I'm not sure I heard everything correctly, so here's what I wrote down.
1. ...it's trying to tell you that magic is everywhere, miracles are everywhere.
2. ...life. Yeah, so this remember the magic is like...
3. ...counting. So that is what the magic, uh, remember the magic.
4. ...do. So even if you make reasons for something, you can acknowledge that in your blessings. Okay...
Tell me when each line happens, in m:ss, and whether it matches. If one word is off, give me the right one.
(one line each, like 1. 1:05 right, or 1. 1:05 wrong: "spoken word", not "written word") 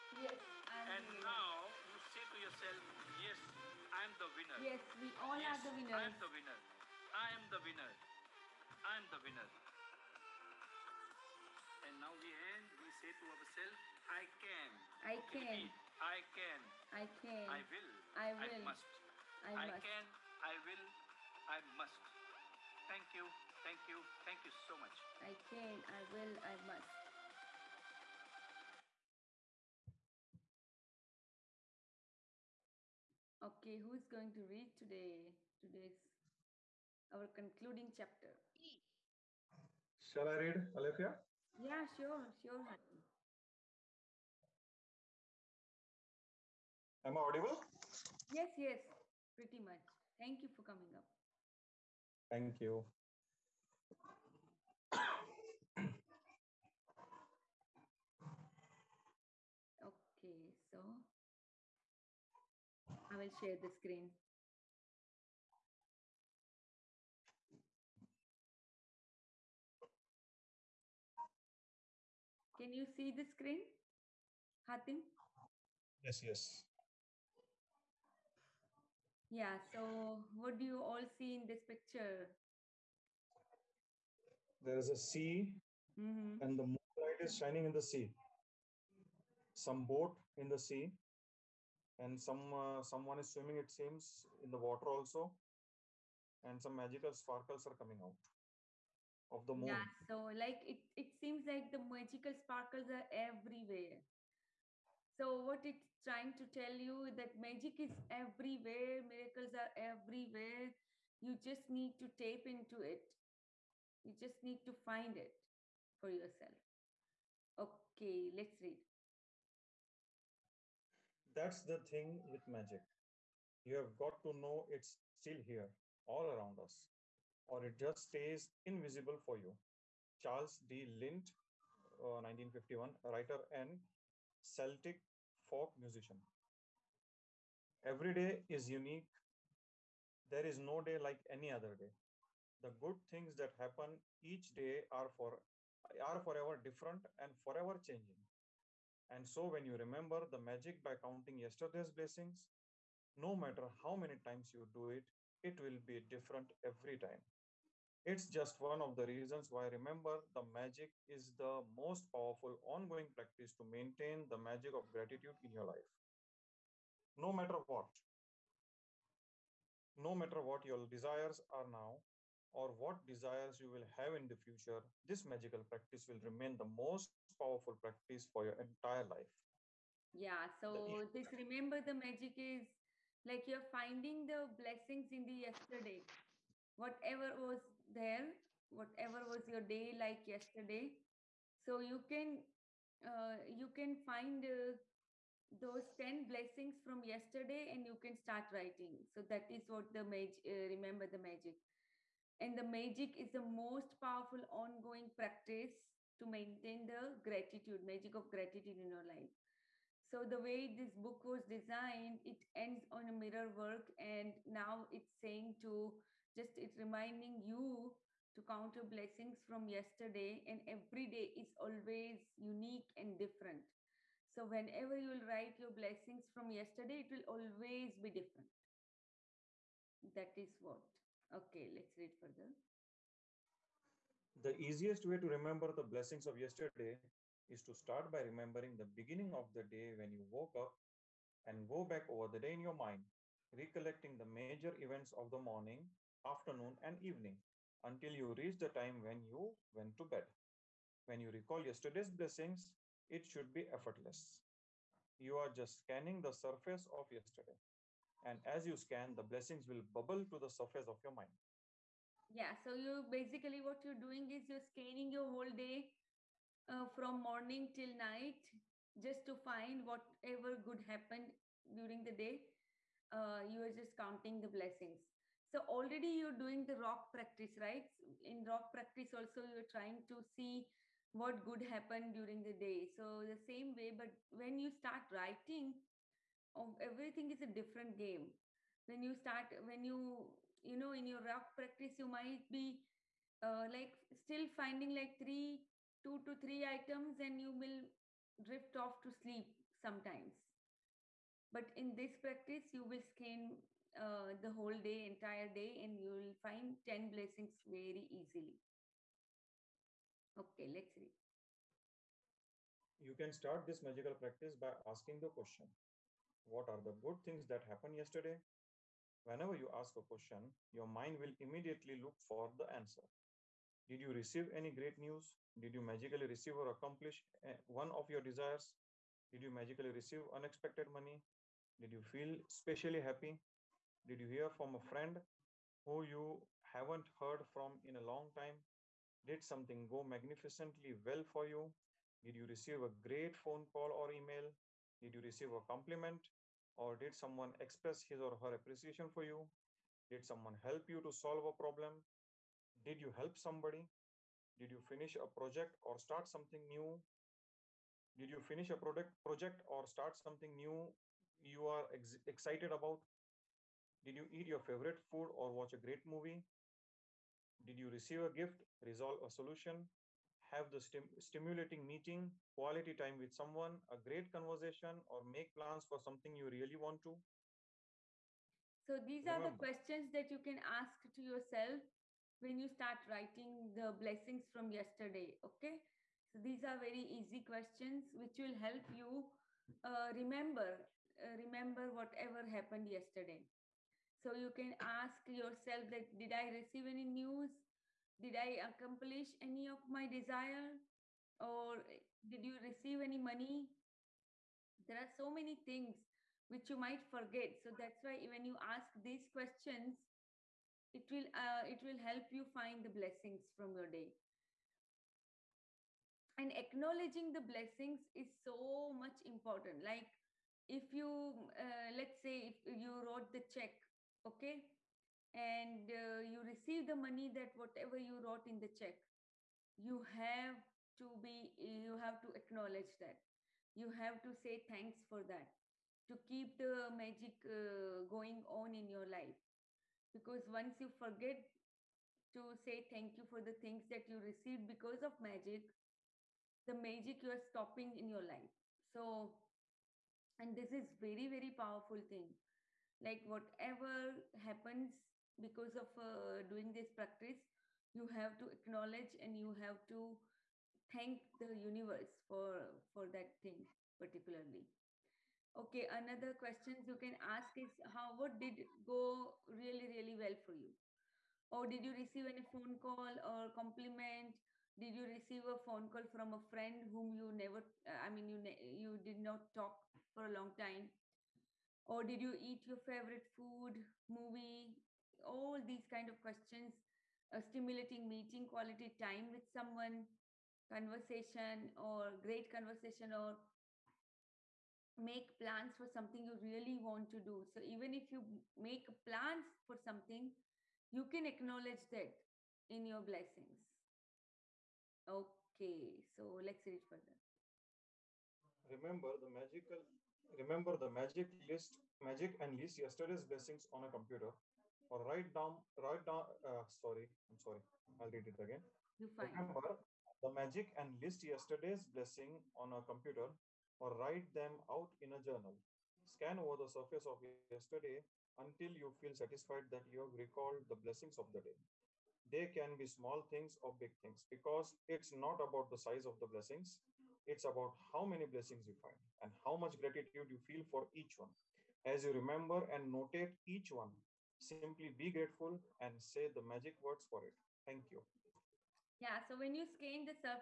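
1. 1:45 right
2. 2:59 right
3. 3:18 wrong: "writing", not "counting"
4. 8:17 wrong: "plans", not "reasons".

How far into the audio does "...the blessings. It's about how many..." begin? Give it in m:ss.
8:56.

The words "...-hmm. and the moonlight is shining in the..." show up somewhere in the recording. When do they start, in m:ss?
1:26.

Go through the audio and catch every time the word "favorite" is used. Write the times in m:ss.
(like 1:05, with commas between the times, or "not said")
6:04, 8:02.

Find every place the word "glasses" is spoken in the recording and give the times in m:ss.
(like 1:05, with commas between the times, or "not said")
not said.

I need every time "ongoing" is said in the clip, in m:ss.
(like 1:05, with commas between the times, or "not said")
2:42, 3:24.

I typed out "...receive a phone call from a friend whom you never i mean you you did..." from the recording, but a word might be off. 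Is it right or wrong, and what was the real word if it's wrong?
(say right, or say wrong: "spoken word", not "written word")
right.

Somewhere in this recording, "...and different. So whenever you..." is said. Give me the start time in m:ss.
3:42.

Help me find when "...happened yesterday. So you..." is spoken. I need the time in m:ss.
6:32.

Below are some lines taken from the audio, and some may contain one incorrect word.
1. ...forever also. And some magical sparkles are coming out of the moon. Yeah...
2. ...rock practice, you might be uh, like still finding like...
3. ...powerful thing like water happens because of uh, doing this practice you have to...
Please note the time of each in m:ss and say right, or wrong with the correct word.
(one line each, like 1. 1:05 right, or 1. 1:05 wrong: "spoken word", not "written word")
1. 1:34 wrong: "water", not "forever"
2. 4:51 right
3. 7:31 wrong: "whatever", not "water".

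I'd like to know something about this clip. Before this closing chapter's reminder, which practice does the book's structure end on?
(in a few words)
mirror work.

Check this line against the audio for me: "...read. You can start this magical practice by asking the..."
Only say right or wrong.
right.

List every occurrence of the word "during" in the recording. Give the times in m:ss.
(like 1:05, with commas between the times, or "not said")
4:31, 4:42.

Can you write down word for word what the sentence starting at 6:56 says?
And acknowledging the blessings is so much important.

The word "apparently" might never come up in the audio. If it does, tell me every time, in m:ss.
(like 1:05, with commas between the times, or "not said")
not said.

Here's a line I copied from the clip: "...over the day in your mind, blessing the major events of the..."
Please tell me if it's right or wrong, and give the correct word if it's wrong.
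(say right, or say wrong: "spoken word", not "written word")
wrong: "recollecting", not "blessing".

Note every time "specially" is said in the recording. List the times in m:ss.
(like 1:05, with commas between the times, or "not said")
5:32.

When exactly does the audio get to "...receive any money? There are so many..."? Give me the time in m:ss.
6:42.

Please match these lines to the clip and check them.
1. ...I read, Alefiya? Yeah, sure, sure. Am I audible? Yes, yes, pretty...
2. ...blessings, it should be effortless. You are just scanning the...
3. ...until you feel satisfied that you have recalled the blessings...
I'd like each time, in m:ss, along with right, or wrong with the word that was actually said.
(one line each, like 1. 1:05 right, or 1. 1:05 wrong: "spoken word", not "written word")
1. 0:40 right
2. 4:12 right
3. 8:48 right.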